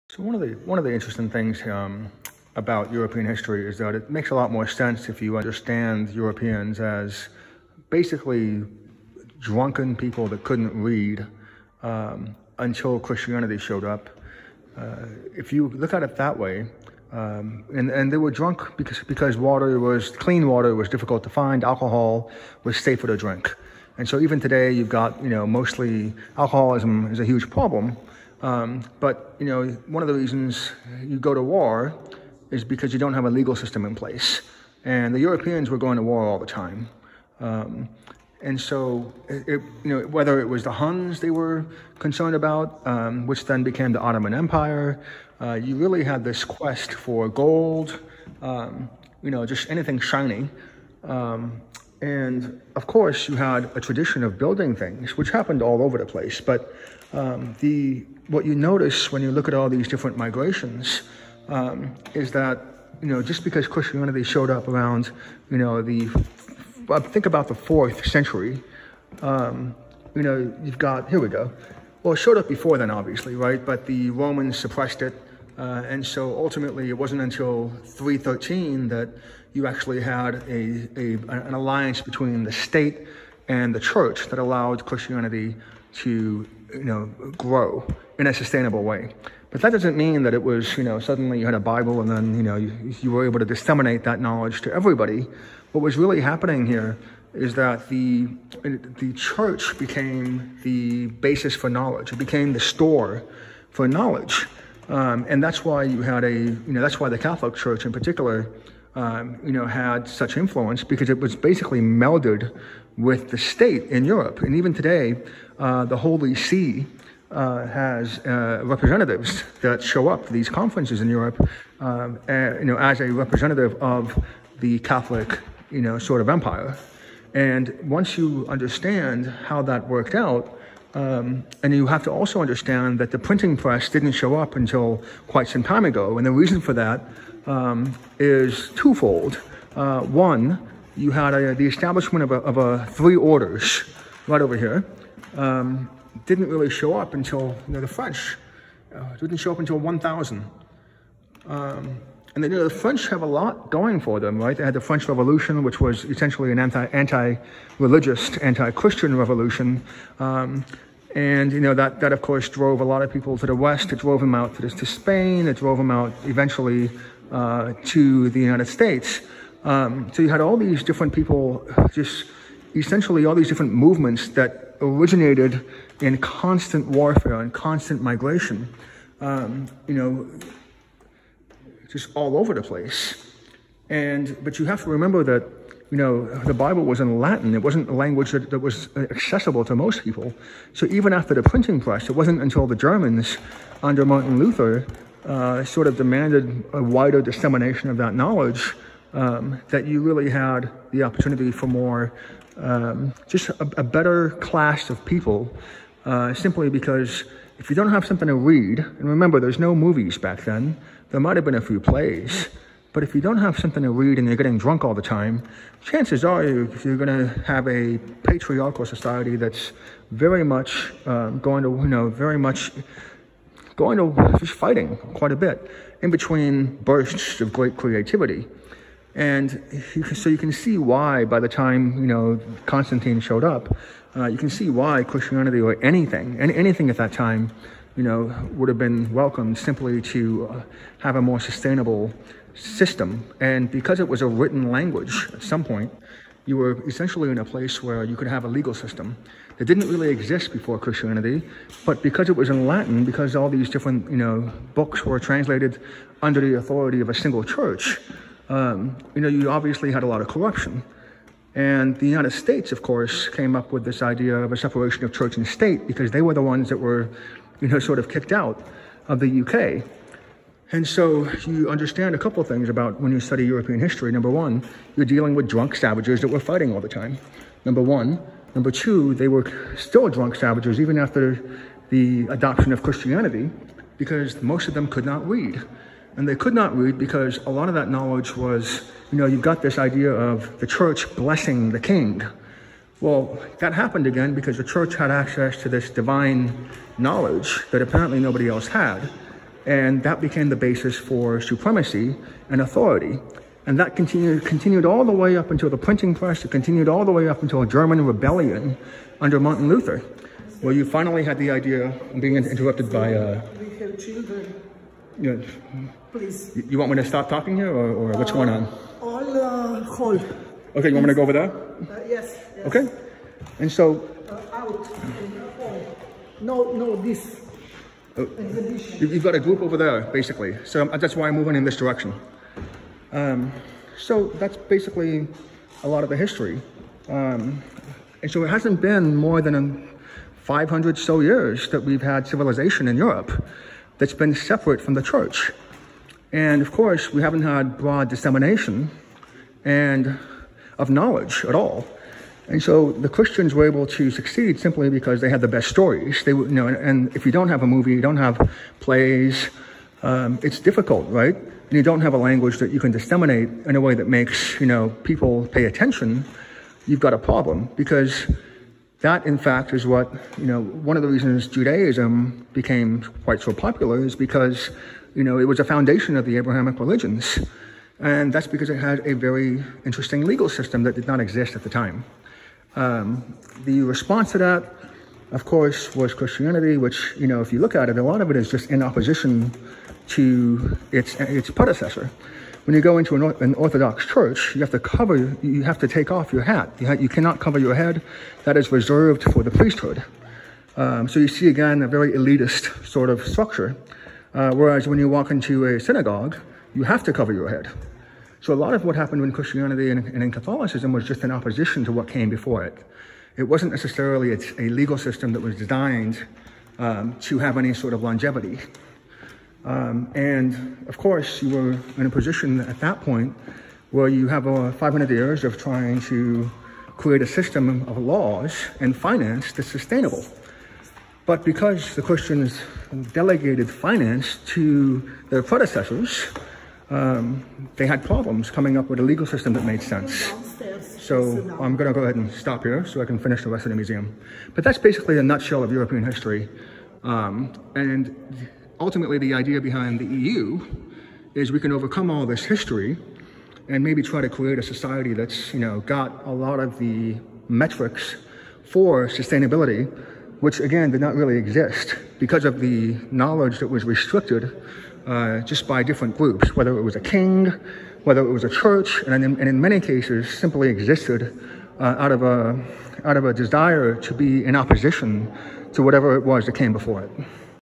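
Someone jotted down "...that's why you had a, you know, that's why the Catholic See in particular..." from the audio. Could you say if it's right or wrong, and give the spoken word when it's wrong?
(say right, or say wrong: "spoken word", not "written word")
wrong: "Church", not "See".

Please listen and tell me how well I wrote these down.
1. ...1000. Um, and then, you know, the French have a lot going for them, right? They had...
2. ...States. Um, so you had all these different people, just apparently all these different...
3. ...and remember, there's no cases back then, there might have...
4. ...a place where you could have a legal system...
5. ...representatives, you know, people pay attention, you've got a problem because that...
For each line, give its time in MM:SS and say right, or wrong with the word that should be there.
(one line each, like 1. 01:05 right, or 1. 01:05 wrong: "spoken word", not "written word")
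1. 02:29 right
2. 02:48 wrong: "essentially", not "apparently"
3. 03:28 wrong: "movies", not "cases"
4. 04:07 right
5. 06:04 wrong: "makes", not "representatives".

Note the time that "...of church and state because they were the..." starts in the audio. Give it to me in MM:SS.
04:25.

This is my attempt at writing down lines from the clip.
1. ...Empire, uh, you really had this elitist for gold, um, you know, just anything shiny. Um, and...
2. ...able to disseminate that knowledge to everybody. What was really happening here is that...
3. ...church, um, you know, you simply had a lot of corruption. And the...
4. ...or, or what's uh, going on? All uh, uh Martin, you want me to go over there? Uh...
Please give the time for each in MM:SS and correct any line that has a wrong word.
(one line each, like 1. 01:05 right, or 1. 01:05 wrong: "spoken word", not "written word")
1. 00:44 wrong: "quest", not "elitist"
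2. 01:33 right
3. 04:17 wrong: "obviously", not "simply"
4. 05:17 wrong: "Okay", not "Martin".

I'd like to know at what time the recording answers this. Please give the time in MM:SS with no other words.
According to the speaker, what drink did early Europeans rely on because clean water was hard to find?
00:21.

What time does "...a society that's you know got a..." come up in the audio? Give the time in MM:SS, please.
07:34.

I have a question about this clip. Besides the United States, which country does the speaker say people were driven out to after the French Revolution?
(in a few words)
Spain.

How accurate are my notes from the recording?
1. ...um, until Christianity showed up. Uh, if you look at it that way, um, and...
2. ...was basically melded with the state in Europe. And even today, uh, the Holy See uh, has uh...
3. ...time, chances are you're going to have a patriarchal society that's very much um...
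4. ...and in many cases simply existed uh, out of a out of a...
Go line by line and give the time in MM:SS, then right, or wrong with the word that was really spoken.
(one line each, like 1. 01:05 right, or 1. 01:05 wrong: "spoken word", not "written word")
1. 00:11 right
2. 01:51 right
3. 03:35 right
4. 07:49 right.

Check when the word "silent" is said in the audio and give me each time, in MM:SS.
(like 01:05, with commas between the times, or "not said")
not said.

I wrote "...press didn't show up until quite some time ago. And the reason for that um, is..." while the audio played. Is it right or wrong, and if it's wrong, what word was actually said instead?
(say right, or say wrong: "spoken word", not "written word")
right.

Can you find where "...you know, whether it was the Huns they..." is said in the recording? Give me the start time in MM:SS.
00:39.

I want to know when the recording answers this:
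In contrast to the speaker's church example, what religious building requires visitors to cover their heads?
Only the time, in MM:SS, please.
06:45.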